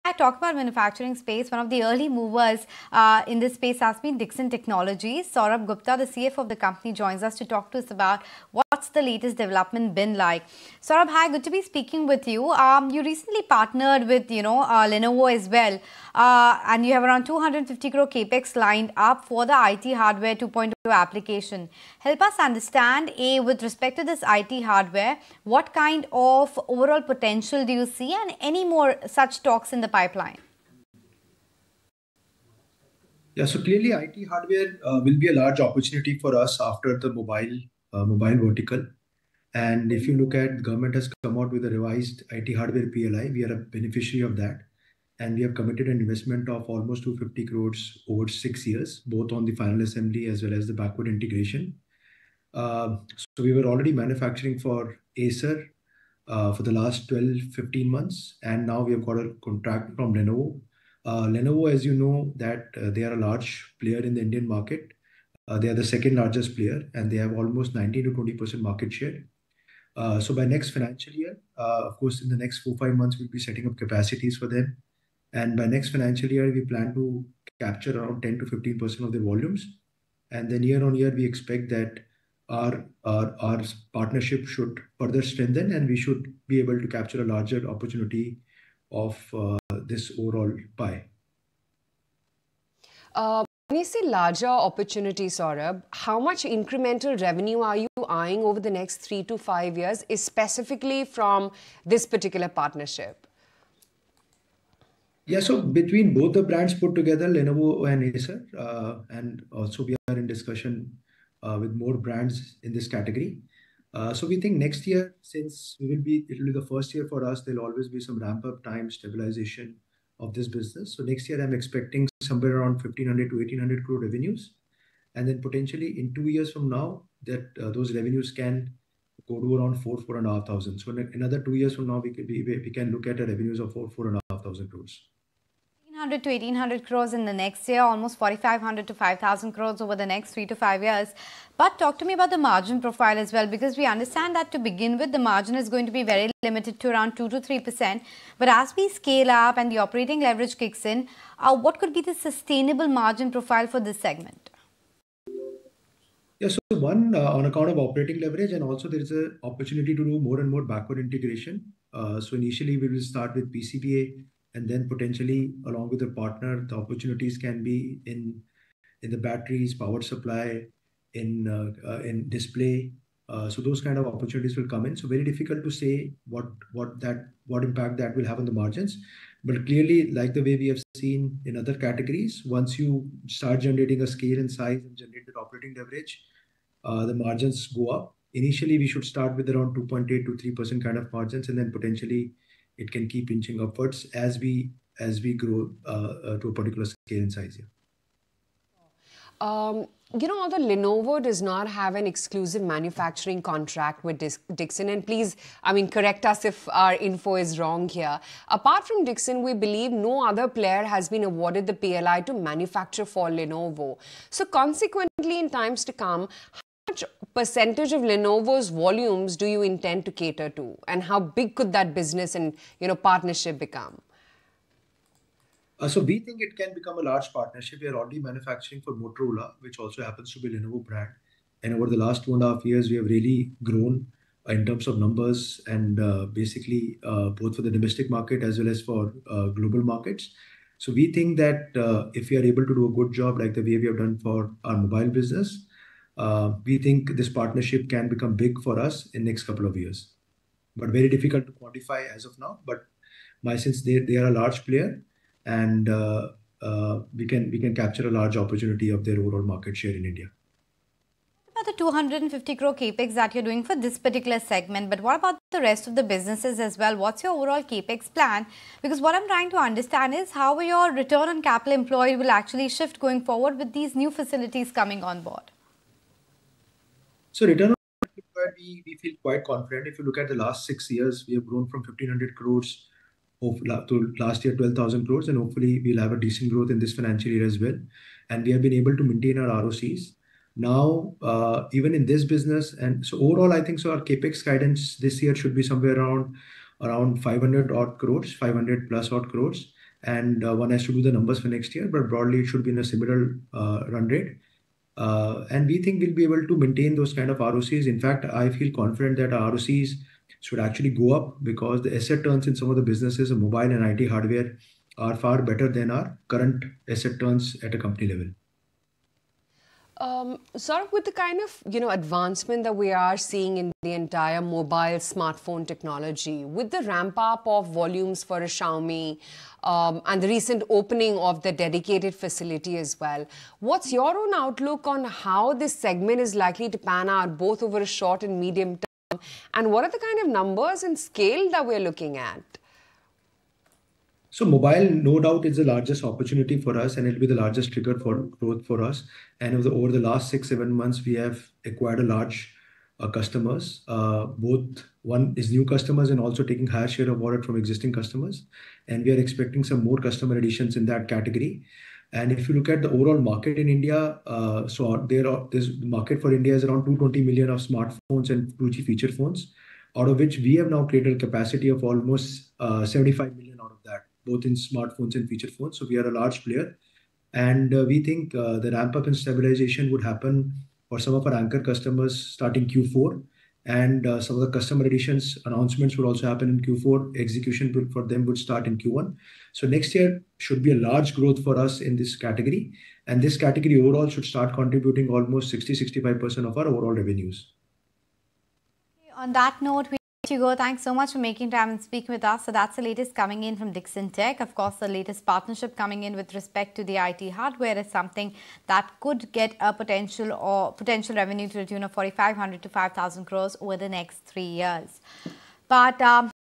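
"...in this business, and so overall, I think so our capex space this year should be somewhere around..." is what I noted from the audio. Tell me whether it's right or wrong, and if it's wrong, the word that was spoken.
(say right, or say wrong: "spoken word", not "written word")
wrong: "guidance", not "space".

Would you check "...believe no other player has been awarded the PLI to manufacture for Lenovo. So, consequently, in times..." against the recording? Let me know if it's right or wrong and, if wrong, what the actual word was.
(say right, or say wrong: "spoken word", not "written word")
right.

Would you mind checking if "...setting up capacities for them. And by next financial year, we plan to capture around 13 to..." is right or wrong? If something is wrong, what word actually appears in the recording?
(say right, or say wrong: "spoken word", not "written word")
wrong: "10", not "13".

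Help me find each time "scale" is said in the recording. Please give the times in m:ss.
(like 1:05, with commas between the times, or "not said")
2:28, 3:04, 3:16, 5:40.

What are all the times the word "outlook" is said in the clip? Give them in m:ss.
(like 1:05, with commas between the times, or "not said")
5:34.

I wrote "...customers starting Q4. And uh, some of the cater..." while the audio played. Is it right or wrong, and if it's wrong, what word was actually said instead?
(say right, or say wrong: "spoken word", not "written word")
wrong: "customer", not "cater".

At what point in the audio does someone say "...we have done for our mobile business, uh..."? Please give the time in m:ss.
4:03.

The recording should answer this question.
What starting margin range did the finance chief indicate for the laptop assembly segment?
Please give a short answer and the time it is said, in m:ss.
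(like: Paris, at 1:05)
2.8 to 3 percent, at 3:09.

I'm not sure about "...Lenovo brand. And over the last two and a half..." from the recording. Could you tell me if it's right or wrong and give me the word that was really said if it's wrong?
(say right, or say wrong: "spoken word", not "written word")
right.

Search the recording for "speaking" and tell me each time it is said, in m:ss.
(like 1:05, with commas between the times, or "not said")
0:11, 6:41.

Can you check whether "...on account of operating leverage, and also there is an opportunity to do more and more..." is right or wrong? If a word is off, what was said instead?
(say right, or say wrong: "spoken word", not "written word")
right.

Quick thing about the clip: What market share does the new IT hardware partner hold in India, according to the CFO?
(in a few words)
19 to 20 percent.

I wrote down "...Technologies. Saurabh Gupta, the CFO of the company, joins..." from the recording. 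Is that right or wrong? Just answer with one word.
right.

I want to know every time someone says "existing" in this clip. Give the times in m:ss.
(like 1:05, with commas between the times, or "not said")
5:57.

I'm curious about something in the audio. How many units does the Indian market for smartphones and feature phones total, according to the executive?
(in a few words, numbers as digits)
220 million.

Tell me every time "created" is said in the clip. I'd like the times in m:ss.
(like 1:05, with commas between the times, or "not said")
6:10.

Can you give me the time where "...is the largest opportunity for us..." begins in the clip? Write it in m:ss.
5:45.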